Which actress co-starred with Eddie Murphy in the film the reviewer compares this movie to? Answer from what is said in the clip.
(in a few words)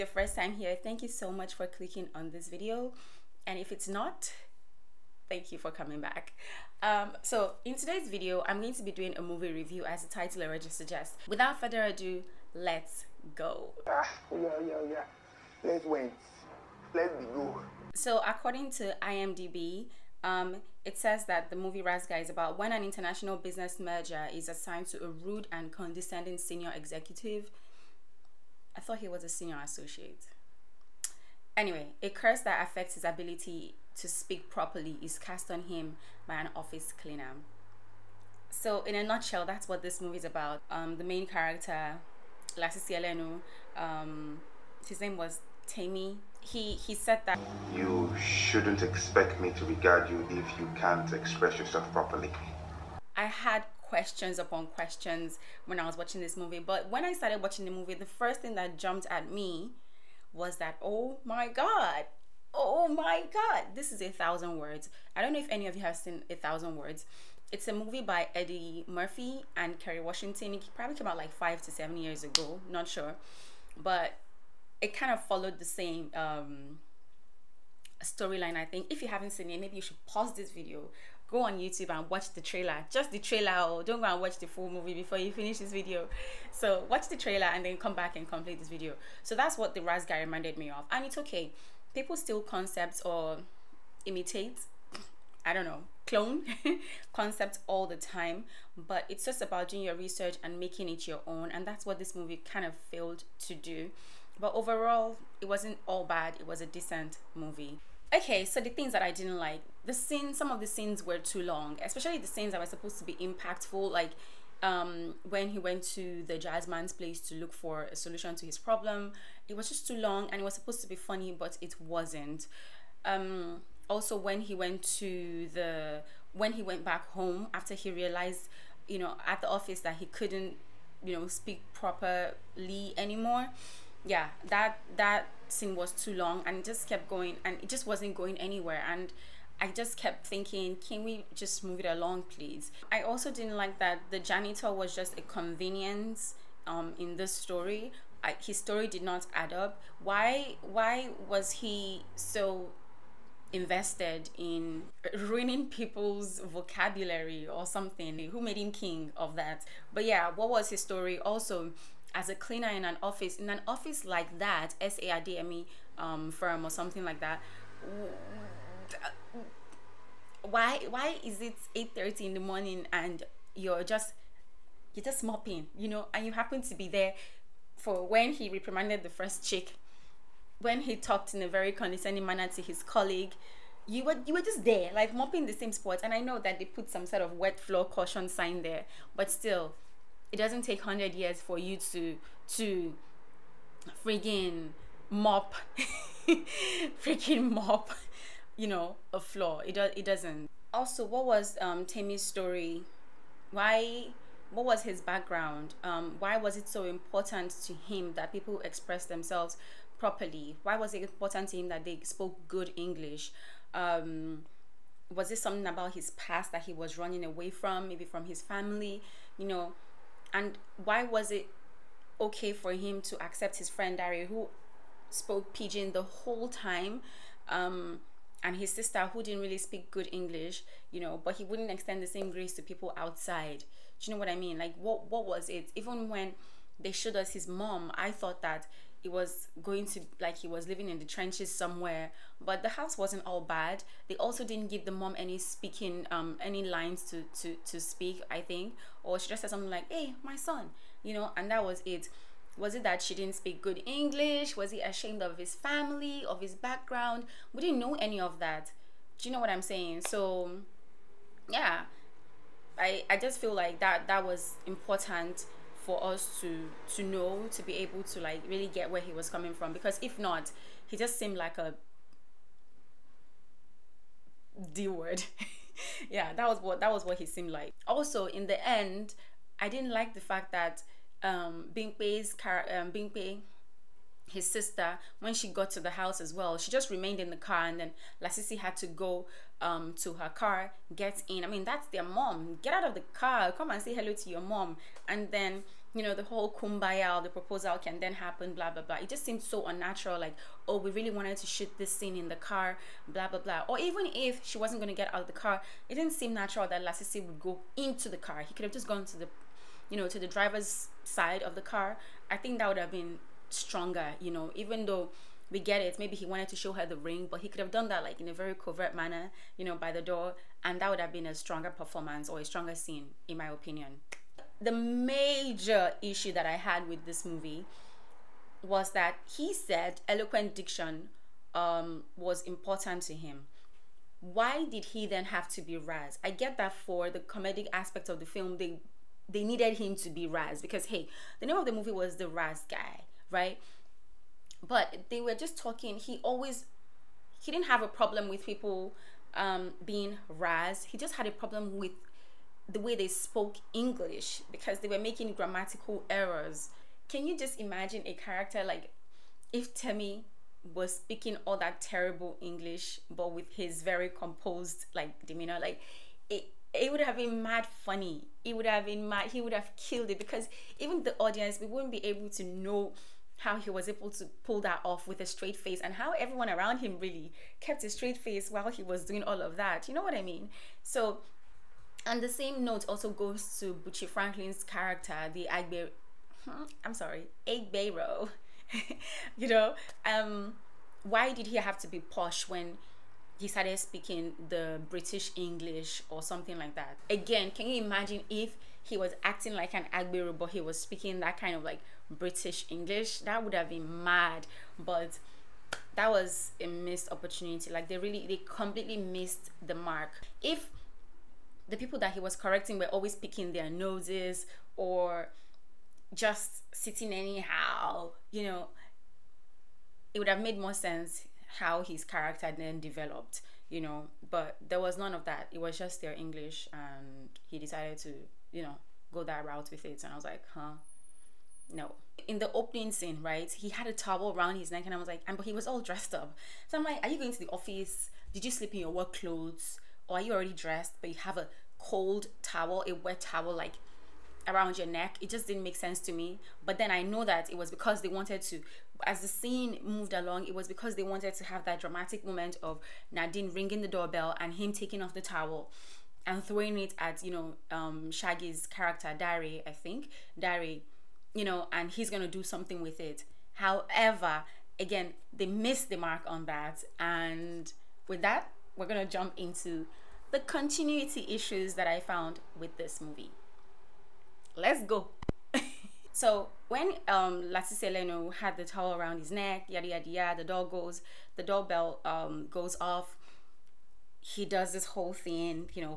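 Kerry Washington.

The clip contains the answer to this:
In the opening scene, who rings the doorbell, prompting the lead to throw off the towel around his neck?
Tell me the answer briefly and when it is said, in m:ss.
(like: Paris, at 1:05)
Nadine, at 7:33.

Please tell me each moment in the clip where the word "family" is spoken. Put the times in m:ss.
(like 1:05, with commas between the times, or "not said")
3:38, 4:15.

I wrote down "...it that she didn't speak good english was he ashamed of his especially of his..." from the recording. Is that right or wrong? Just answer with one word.
wrong.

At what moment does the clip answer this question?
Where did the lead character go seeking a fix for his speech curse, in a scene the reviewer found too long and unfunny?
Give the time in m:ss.
1:56.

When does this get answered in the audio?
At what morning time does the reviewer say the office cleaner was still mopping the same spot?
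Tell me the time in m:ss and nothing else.
2:51.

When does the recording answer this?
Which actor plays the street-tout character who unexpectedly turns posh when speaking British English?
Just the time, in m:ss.
6:23.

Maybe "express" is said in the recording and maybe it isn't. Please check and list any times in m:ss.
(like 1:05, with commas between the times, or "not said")
0:51, 3:28.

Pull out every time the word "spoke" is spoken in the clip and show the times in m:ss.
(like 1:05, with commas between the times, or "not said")
3:32, 3:45, 5:53.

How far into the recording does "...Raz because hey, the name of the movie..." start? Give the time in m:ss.
5:40.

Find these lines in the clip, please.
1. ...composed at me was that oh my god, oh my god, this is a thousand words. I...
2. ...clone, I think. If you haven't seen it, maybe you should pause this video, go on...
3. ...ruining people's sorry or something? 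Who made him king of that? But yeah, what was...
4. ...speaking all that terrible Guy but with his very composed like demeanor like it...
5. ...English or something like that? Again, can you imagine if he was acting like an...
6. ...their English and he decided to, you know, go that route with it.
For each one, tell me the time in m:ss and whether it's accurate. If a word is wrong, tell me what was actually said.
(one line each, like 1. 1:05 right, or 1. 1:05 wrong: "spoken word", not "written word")
1. 0:58 wrong: "jumped", not "composed"
2. 1:18 wrong: "storyline", not "clone"
3. 2:35 wrong: "vocabulary", not "sorry"
4. 6:00 wrong: "English", not "Guy"
5. 6:35 right
6. 7:06 right.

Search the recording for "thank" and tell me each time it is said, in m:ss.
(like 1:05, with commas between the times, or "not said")
0:00, 0:05.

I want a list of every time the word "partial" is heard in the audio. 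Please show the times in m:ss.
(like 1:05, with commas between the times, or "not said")
not said.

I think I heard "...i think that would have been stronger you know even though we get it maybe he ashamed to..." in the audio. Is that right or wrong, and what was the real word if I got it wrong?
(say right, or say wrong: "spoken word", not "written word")
wrong: "wanted", not "ashamed".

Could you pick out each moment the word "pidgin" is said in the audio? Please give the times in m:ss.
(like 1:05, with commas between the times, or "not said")
3:45.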